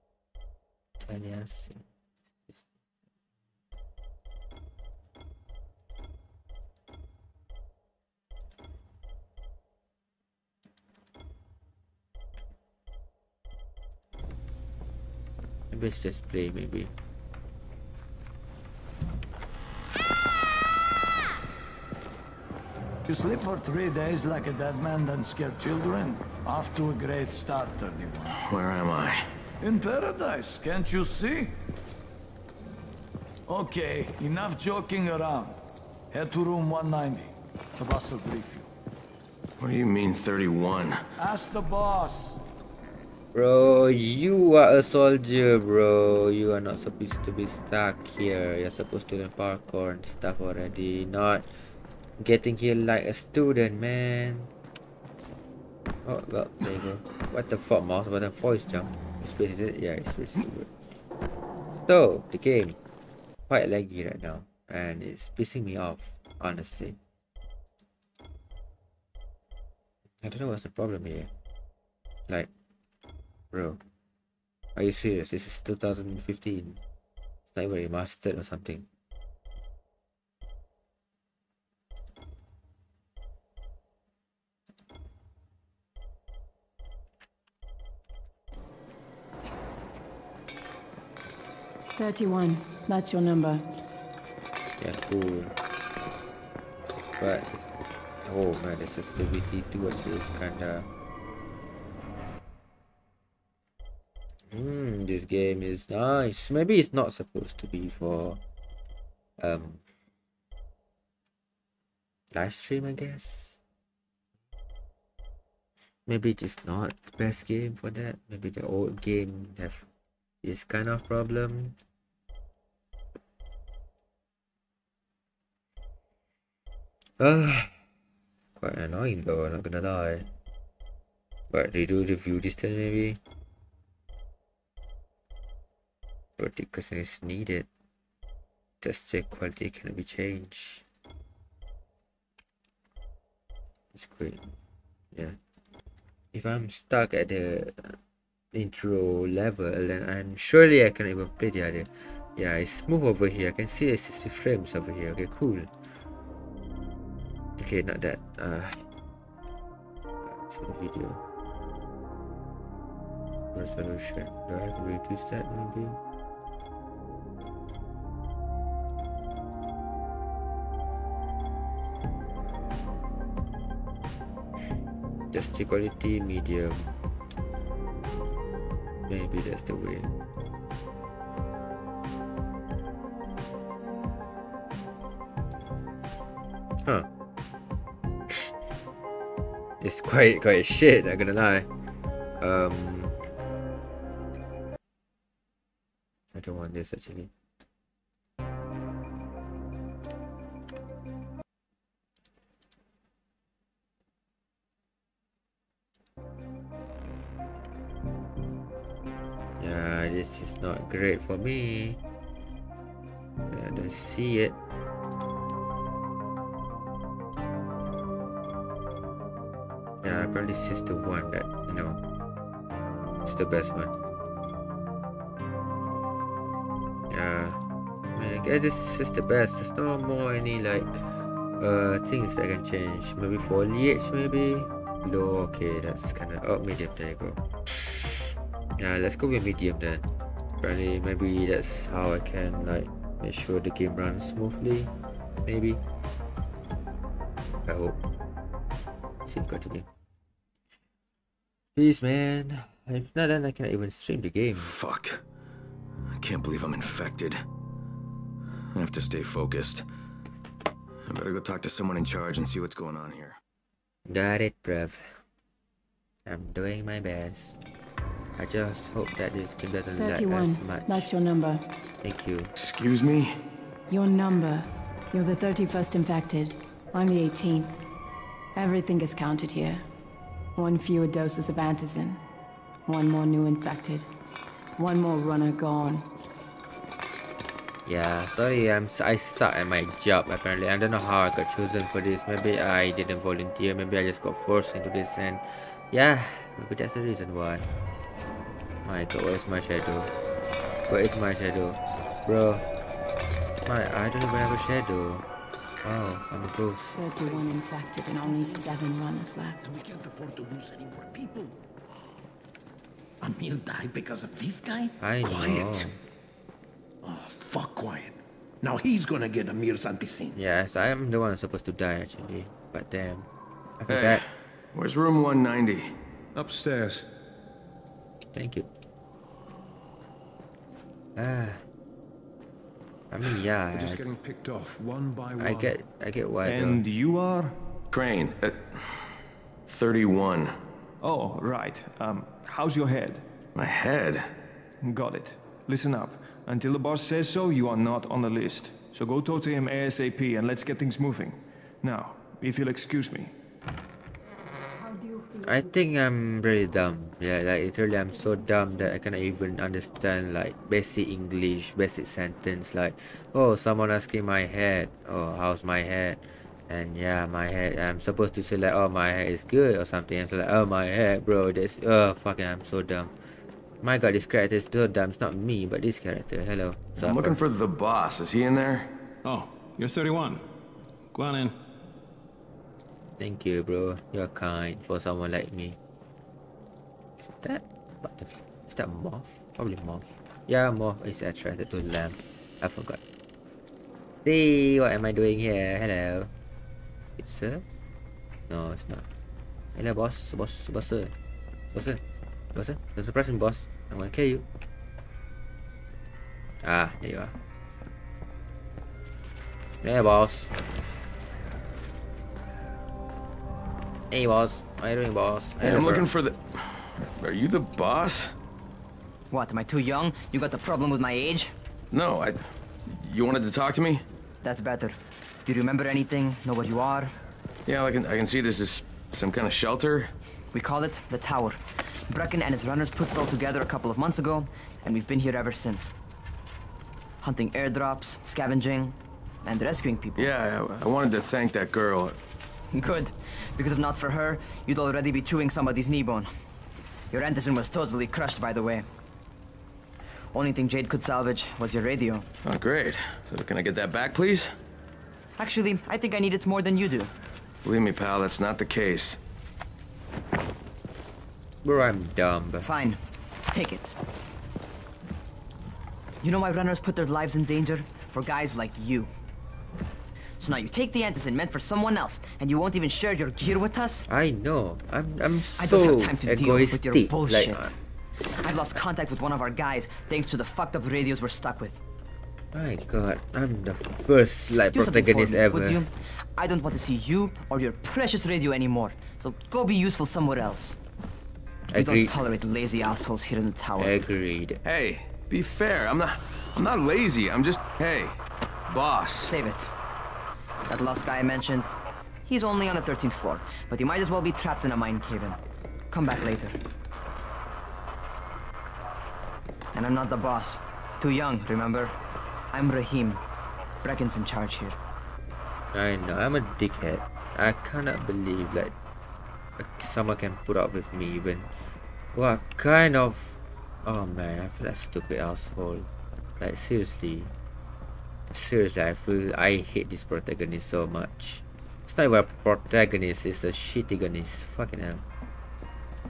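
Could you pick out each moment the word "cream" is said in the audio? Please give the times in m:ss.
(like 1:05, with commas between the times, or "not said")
not said.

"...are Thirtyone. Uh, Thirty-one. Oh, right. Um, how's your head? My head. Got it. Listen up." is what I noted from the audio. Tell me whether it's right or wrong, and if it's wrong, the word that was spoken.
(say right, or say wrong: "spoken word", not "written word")
wrong: "Crane", not "Thirtyone".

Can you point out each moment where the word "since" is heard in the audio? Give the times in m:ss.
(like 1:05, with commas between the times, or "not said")
7:15.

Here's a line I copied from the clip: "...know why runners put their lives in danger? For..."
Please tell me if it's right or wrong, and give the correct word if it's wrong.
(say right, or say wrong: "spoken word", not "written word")
right.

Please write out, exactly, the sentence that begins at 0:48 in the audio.
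You're supposed to learn parkour and stuff already, not Getting here like a student, man.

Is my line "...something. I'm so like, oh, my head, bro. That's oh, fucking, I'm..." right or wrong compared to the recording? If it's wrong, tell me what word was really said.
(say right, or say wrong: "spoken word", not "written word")
right.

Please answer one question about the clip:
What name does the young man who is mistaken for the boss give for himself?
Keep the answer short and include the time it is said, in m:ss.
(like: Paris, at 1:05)
Rahim, at 8:32.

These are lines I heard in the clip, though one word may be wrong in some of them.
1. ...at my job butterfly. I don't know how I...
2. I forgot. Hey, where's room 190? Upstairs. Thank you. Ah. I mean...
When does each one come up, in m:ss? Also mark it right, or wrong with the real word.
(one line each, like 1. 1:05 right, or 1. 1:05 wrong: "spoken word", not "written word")
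1. 4:49 wrong: "apparently", not "butterfly"
2. 5:23 right.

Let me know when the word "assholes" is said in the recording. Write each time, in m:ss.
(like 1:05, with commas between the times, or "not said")
8:12, 8:45.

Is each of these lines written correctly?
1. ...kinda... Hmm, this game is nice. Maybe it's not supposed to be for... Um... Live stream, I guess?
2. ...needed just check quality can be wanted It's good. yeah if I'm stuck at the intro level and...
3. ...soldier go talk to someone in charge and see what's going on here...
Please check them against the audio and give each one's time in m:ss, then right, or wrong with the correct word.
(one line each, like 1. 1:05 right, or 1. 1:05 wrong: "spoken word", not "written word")
1. 1:40 right
2. 2:17 wrong: "changed", not "wanted"
3. 4:21 wrong: "better", not "soldier".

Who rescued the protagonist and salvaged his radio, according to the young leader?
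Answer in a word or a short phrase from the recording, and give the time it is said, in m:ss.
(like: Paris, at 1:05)
Jade, at 7:30.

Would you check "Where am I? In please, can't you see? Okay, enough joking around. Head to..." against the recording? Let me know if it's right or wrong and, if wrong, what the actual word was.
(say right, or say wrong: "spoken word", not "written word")
wrong: "paradise", not "please".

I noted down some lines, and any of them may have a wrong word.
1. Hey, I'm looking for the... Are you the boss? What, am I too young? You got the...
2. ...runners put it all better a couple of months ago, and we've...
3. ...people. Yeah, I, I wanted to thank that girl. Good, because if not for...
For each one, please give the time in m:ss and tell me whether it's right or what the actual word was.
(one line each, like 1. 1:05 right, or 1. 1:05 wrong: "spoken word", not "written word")
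1. 6:55 right
2. 7:12 wrong: "together", not "better"
3. 7:19 right.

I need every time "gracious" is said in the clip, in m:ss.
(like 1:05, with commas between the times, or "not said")
not said.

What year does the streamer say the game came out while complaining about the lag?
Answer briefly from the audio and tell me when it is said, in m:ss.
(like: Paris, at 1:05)
2015, at 1:15.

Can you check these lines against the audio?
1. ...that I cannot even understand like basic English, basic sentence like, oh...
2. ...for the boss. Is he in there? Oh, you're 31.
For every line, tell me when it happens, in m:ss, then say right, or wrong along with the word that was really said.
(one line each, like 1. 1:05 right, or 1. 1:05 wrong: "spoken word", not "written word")
1. 5:58 right
2. 6:17 right.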